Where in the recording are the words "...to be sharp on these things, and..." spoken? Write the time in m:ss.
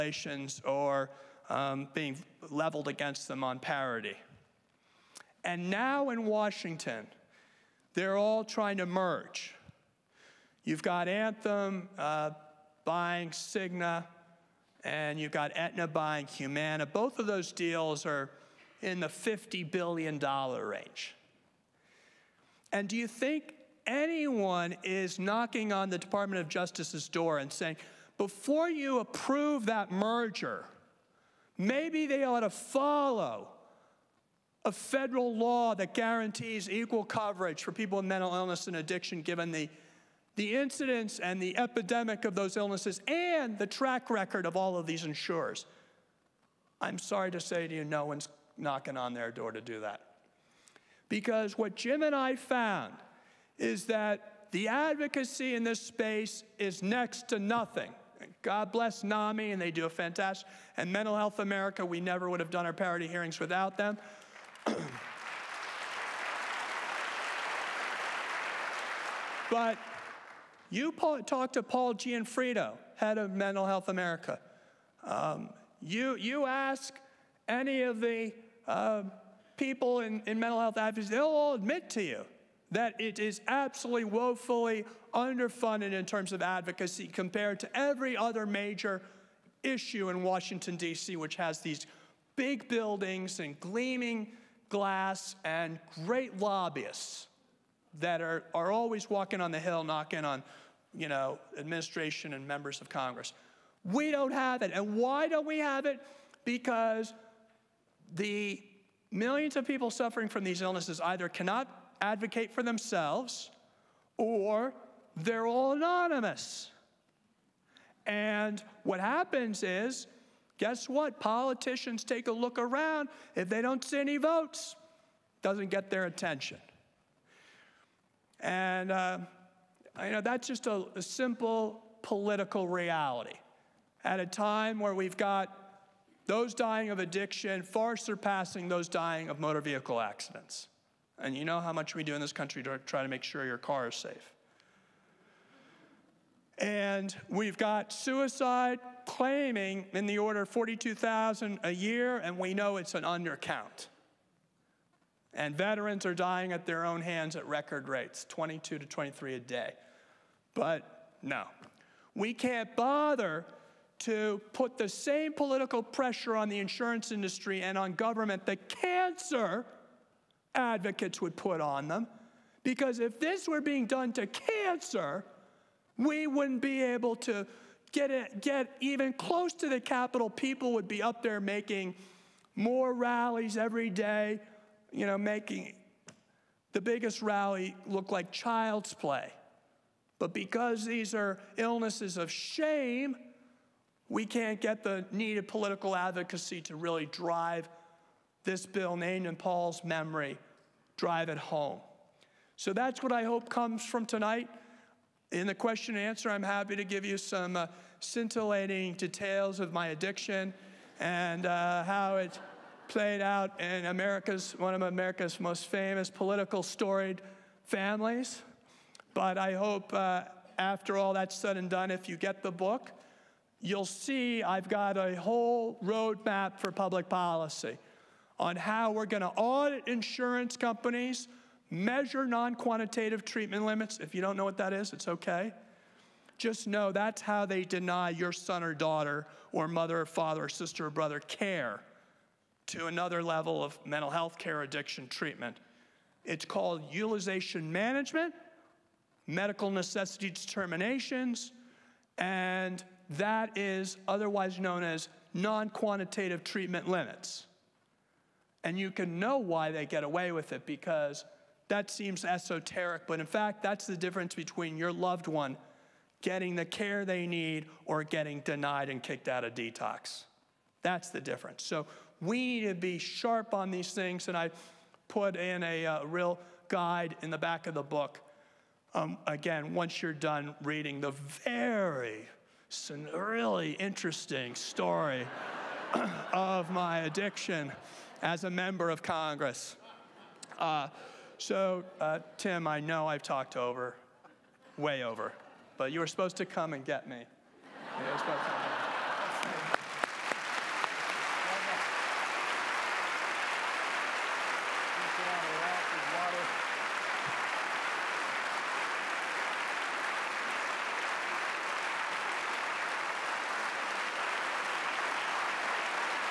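4:32.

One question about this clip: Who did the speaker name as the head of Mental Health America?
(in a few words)
Paul Gianfrido.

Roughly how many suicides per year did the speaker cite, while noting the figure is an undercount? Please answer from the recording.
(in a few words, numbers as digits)
42,000.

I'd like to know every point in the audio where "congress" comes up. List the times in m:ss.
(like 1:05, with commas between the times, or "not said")
1:42, 4:49.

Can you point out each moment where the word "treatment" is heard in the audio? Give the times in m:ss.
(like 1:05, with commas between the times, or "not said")
3:53, 4:05, 4:16.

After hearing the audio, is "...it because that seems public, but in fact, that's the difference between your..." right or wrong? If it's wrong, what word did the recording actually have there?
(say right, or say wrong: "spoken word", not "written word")
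wrong: "esoteric", not "public".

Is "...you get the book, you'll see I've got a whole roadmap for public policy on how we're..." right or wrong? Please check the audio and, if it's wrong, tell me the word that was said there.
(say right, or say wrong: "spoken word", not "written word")
right.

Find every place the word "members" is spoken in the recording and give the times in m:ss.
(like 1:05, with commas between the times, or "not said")
1:42, 4:48.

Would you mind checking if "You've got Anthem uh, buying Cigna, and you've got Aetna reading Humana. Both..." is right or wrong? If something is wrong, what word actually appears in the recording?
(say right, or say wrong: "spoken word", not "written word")
wrong: "buying", not "reading".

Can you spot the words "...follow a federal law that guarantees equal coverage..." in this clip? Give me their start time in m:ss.
0:32.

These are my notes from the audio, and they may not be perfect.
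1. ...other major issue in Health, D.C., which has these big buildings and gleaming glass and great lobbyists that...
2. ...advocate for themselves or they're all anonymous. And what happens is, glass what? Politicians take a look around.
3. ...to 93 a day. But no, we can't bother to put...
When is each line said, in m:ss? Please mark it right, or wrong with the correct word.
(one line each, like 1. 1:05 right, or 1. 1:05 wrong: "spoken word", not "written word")
1. 1:28 wrong: "Washington", not "Health"
2. 1:52 wrong: "guess", not "glass"
3. 2:38 wrong: "23", not "93".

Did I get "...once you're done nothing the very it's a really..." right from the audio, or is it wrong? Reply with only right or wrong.
wrong.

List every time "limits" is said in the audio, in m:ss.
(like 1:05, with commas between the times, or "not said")
3:53, 4:16.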